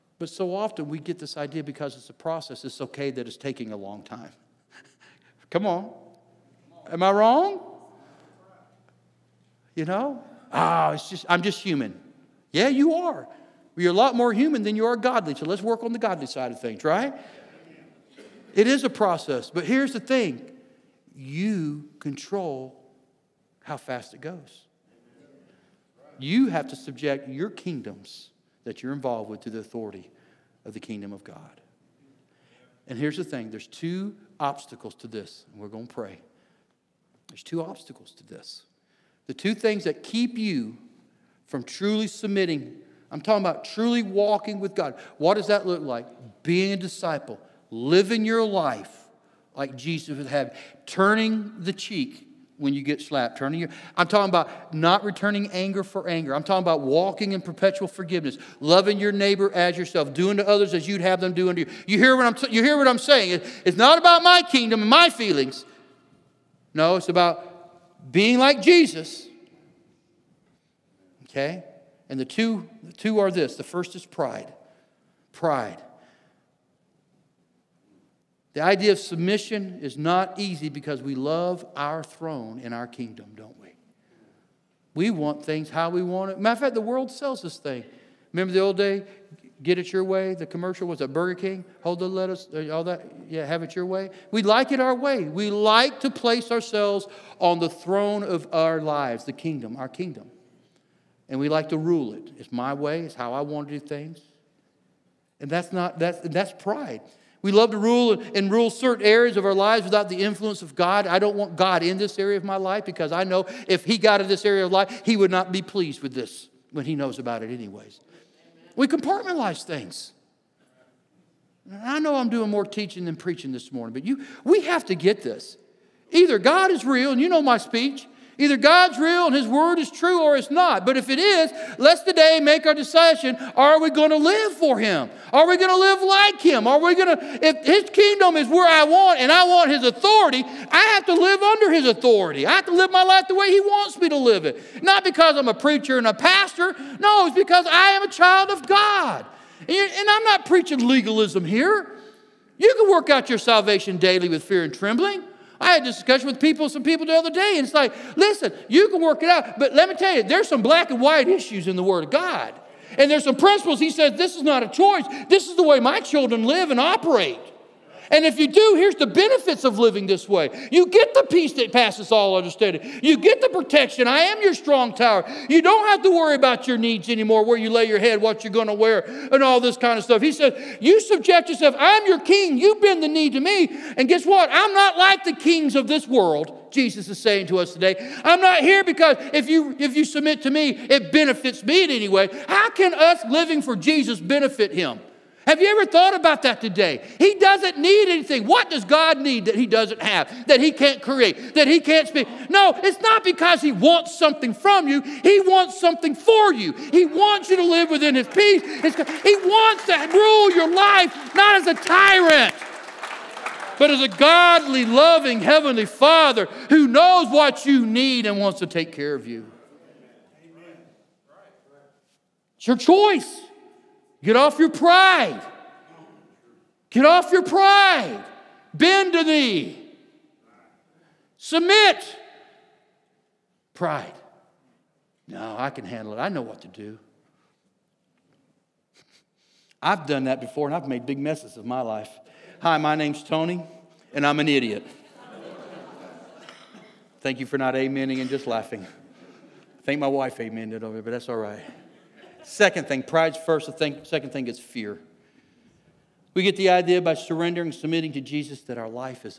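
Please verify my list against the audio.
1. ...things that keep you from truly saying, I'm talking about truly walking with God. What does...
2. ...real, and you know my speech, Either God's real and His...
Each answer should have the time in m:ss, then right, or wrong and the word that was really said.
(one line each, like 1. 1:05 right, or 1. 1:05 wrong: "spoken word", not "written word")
1. 0:39 wrong: "submitting", not "saying"
2. 2:06 right.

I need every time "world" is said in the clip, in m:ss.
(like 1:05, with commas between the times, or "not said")
1:26, 3:06.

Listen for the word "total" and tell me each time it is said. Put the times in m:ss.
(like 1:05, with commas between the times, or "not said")
not said.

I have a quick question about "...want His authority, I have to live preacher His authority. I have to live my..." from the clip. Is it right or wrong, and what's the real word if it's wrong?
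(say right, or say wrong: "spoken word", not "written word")
wrong: "under", not "preacher".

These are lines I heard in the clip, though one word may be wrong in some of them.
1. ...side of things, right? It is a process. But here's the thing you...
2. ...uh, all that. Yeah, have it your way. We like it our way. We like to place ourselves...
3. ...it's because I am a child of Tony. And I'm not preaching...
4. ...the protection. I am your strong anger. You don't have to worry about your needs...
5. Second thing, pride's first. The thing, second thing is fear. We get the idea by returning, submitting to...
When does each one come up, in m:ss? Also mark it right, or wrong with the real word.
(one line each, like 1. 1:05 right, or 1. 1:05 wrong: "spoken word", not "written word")
1. 0:16 right
2. 1:32 right
3. 2:27 wrong: "God", not "Tony"
4. 2:53 wrong: "tower", not "anger"
5. 4:12 wrong: "surrendering", not "returning".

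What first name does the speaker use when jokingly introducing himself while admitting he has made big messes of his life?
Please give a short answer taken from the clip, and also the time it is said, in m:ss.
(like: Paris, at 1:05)
Tony, at 4:03.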